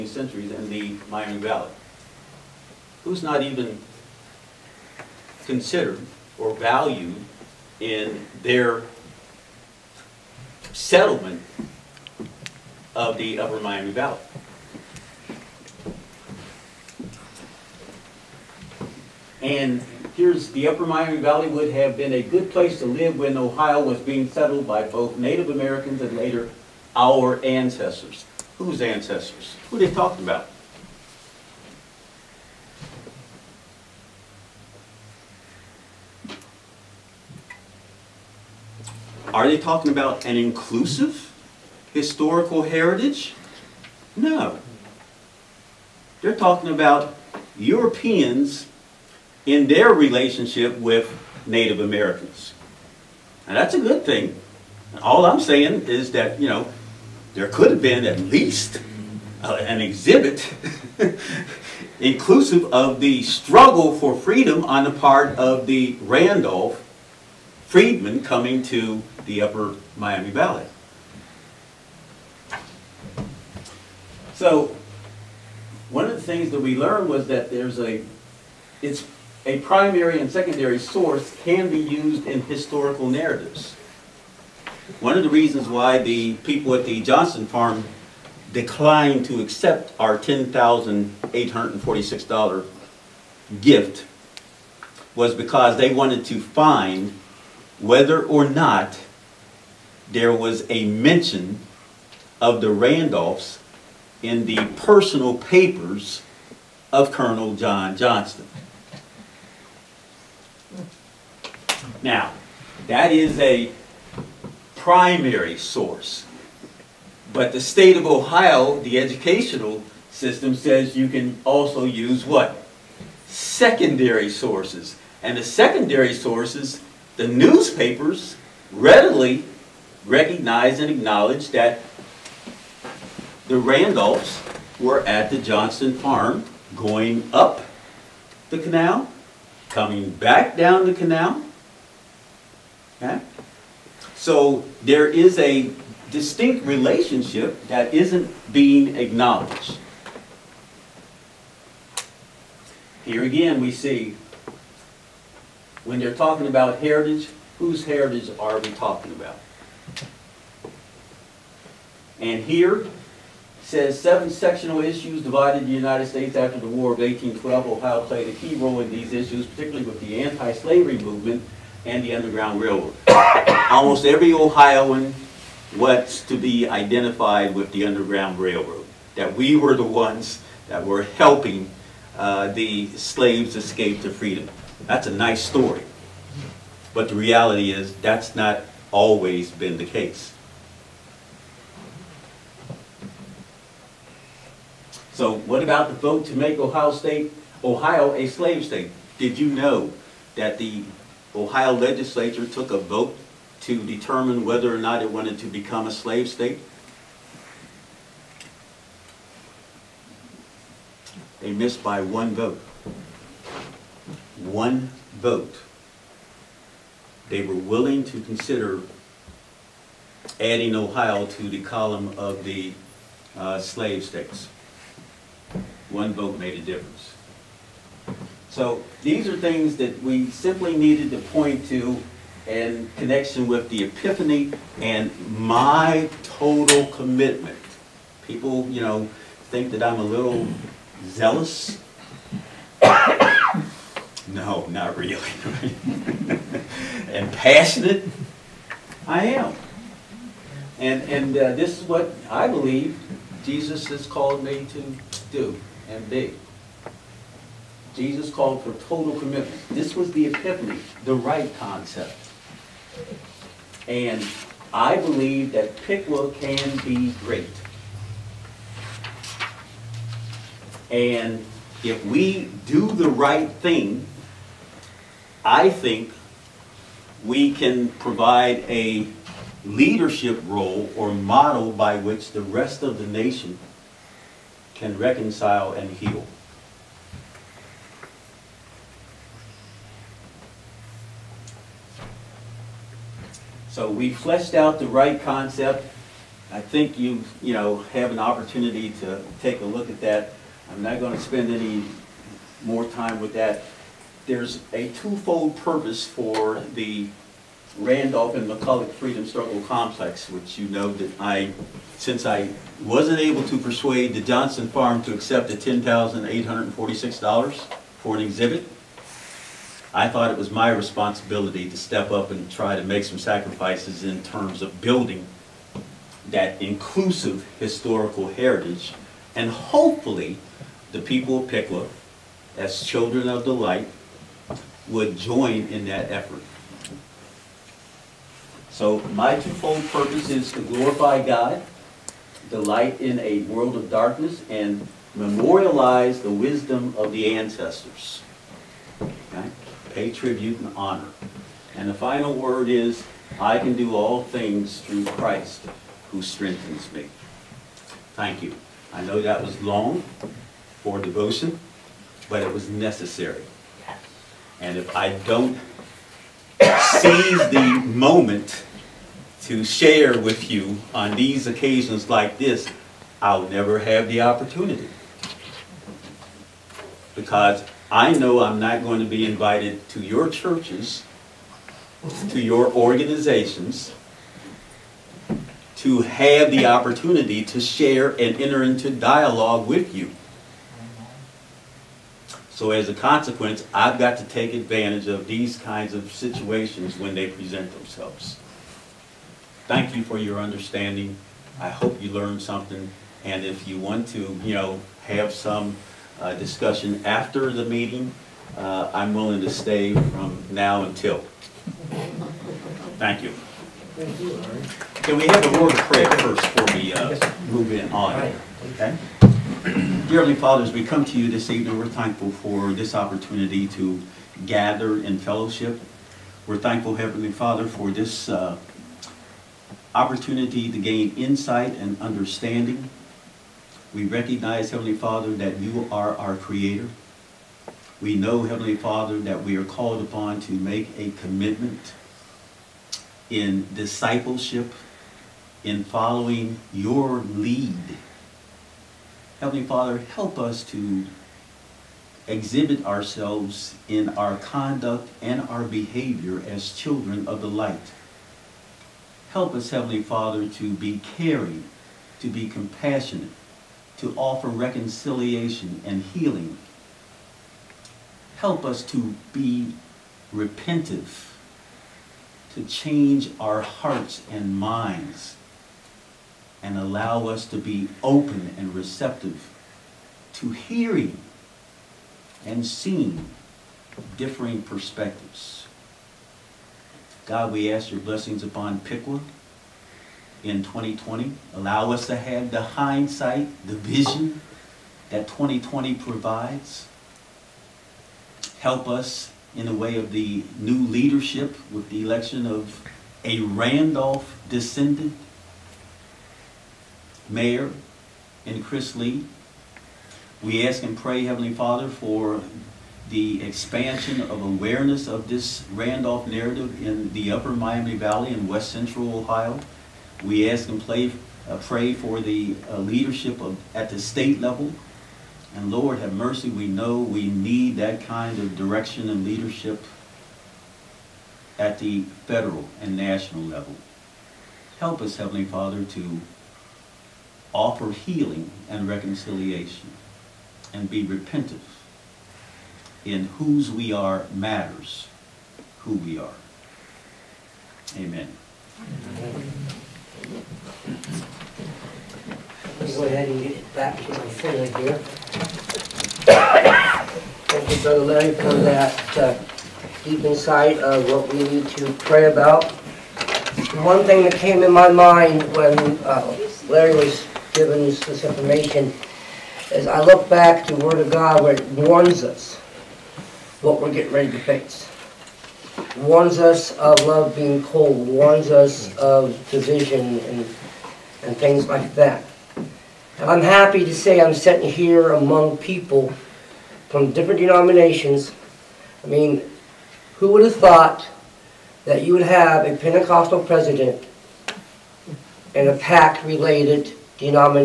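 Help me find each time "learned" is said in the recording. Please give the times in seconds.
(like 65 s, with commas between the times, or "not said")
76 s, 402 s.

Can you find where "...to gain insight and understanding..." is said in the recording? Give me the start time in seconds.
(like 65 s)
430 s.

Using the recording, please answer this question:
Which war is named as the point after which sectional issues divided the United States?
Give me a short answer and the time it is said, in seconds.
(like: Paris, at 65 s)
War of 1812, at 166 s.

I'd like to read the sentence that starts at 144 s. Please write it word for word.
So there is a distinct relationship that isn't being acknowledged.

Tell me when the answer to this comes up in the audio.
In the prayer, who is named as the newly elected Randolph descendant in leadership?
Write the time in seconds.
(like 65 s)
508 s.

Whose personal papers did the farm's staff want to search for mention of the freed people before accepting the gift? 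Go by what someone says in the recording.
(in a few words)
Colonel John Johnston.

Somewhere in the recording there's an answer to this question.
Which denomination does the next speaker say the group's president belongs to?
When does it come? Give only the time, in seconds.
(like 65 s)
592 s.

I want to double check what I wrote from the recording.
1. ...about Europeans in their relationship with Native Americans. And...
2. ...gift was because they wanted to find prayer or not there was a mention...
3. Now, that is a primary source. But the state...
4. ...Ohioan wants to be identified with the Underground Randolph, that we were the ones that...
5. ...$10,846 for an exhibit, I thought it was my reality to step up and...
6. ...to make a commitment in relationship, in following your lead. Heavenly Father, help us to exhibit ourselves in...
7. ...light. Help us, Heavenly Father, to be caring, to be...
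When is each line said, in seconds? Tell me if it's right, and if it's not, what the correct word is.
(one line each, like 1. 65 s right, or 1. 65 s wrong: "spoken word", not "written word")
1. 46 s right
2. 93 s wrong: "whether", not "prayer"
3. 112 s right
4. 174 s wrong: "Railroad", not "Randolph"
5. 315 s wrong: "responsibility", not "reality"
6. 440 s wrong: "discipleship", not "relationship"
7. 457 s right.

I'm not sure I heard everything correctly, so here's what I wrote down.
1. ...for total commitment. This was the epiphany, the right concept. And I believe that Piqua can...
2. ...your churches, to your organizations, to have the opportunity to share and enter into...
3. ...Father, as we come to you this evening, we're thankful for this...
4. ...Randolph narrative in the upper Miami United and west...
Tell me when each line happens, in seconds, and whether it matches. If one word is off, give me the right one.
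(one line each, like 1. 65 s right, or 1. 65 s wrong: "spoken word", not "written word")
1. 258 s right
2. 379 s right
3. 420 s right
4. 515 s wrong: "Valley", not "United".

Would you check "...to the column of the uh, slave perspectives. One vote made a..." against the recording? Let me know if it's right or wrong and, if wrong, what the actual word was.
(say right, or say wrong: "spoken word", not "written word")
wrong: "states", not "perspectives".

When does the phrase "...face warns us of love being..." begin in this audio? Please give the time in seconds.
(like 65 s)
574 s.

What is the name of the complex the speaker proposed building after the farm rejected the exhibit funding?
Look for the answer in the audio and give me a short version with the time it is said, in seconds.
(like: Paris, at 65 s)
Randolph and McCulloch Freedom Struggle Complex, at 307 s.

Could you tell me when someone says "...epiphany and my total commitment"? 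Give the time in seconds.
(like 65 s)
233 s.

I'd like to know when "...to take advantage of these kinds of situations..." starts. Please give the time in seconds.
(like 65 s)
394 s.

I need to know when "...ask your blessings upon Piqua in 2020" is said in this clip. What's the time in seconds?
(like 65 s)
487 s.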